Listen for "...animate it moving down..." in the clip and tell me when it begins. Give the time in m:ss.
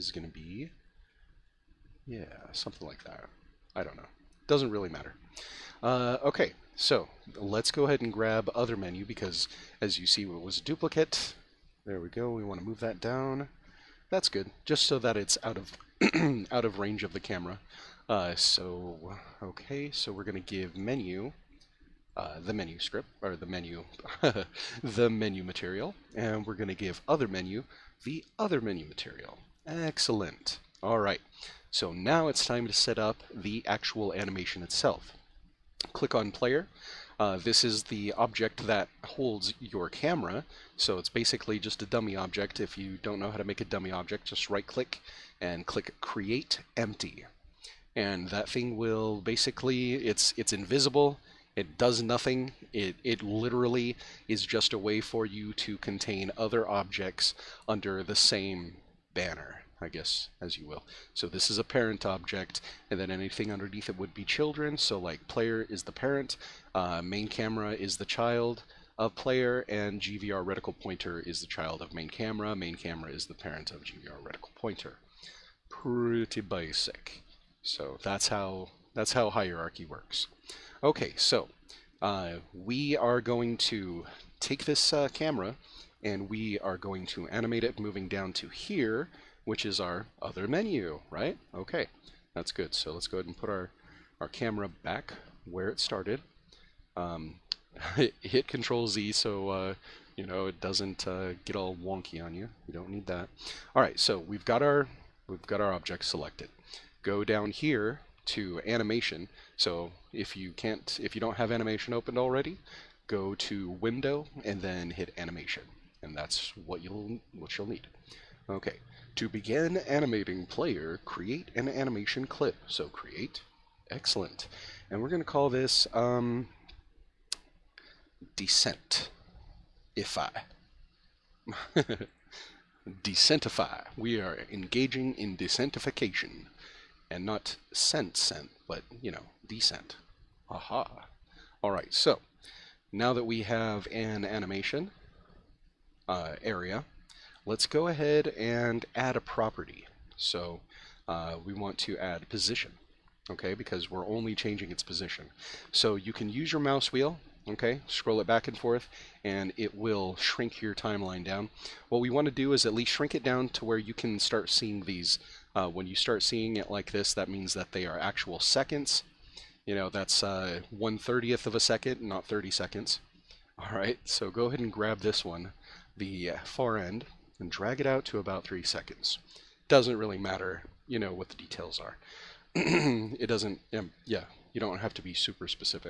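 1:27.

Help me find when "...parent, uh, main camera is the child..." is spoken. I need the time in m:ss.
1:05.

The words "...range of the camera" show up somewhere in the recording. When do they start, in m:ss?
0:16.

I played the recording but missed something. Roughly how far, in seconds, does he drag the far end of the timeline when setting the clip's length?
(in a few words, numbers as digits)
3 seconds.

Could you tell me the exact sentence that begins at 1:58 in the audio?
Okay, to begin animating player, create an animation clip.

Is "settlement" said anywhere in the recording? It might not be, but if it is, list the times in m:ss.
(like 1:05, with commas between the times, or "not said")
not said.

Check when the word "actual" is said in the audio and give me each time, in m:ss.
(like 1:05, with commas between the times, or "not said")
0:33, 2:47.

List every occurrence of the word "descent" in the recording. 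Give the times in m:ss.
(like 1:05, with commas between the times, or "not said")
2:08, 2:19.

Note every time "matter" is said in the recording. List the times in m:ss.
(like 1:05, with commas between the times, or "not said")
0:04, 3:00.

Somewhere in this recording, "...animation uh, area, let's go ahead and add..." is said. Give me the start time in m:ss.
2:24.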